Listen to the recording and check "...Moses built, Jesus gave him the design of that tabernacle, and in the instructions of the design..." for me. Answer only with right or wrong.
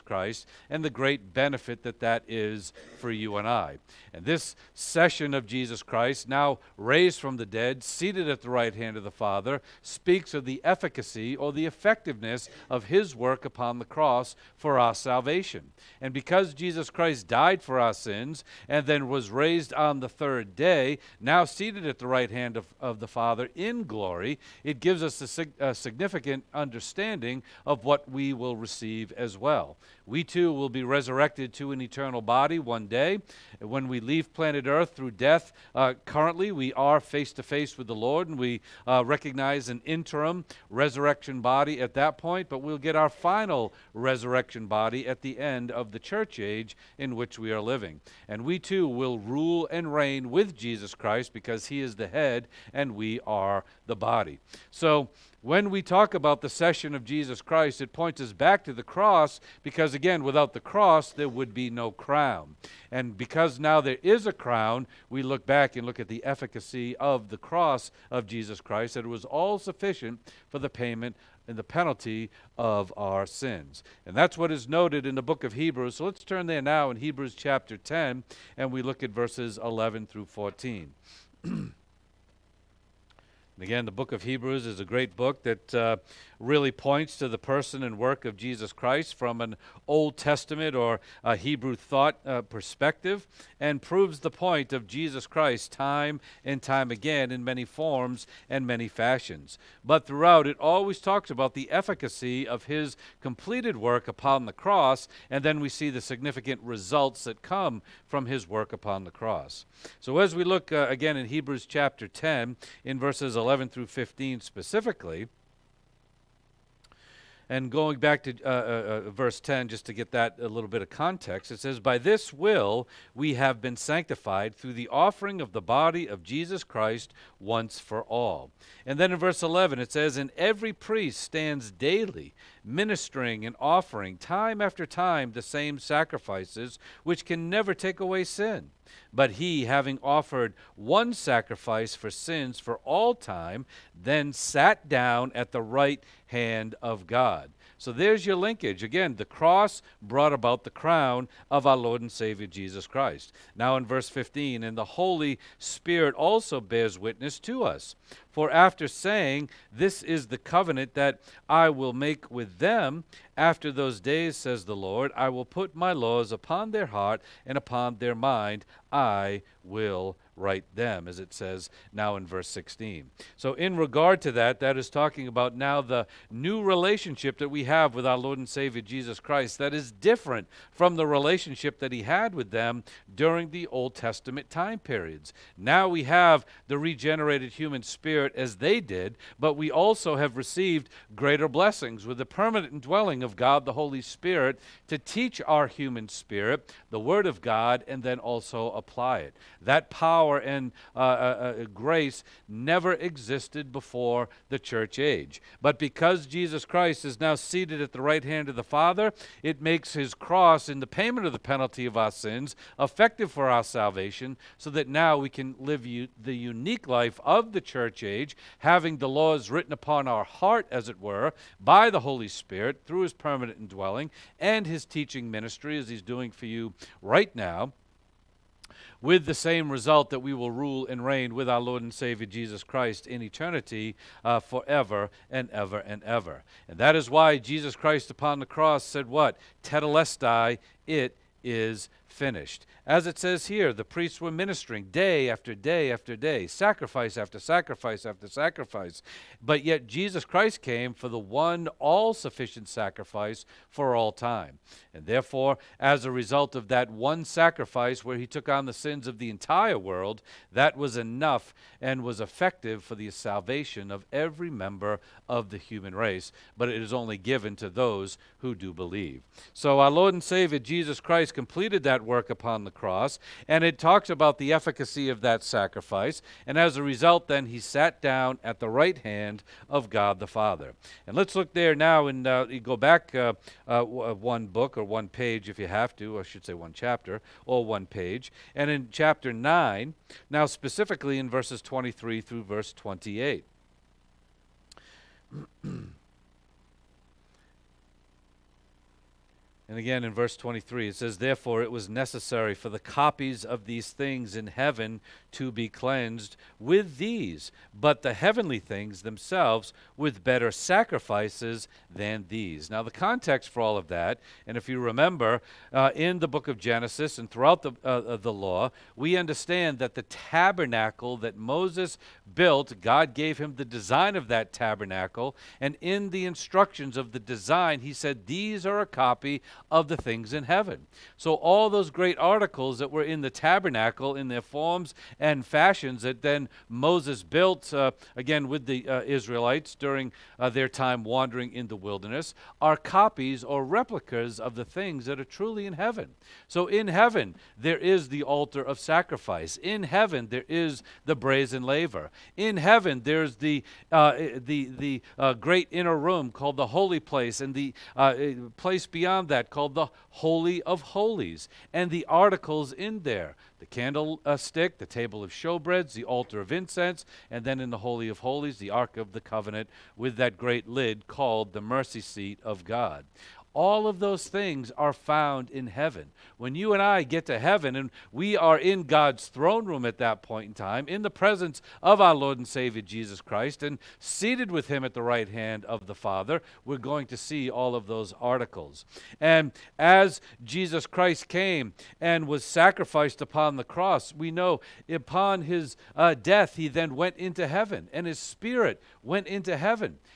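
wrong.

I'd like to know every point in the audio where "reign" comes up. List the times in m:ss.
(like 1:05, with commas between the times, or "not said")
0:49, 3:51.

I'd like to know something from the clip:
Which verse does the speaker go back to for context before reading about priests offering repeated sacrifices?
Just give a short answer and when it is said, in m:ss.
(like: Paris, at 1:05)
Verse 10, at 1:59.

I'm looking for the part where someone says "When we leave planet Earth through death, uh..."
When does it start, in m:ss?
0:33.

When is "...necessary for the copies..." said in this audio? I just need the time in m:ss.
5:01.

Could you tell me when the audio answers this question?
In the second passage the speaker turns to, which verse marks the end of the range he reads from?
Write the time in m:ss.
4:52.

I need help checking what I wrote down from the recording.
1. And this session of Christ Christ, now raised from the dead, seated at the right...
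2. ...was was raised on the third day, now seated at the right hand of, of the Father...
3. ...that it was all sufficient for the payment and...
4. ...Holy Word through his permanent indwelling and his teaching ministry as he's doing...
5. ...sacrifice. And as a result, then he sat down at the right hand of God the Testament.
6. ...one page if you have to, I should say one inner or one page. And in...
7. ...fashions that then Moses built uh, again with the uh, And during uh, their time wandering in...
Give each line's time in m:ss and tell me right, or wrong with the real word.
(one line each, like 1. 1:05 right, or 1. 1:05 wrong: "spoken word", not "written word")
1. 0:04 wrong: "Jesus", not "Christ"
2. 0:19 right
3. 1:08 right
4. 3:42 wrong: "Spirit", not "Word"
5. 4:35 wrong: "Father", not "Testament"
6. 4:44 wrong: "chapter", not "inner"
7. 5:35 wrong: "Israelites", not "And".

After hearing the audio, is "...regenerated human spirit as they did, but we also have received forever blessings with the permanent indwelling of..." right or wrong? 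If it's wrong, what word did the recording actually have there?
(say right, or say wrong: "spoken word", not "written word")
wrong: "greater", not "forever".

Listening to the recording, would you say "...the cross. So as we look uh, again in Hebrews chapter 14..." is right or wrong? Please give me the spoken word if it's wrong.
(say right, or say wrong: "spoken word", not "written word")
wrong: "10", not "14".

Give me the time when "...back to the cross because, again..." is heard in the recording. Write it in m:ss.
0:58.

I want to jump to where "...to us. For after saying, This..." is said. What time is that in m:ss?
2:37.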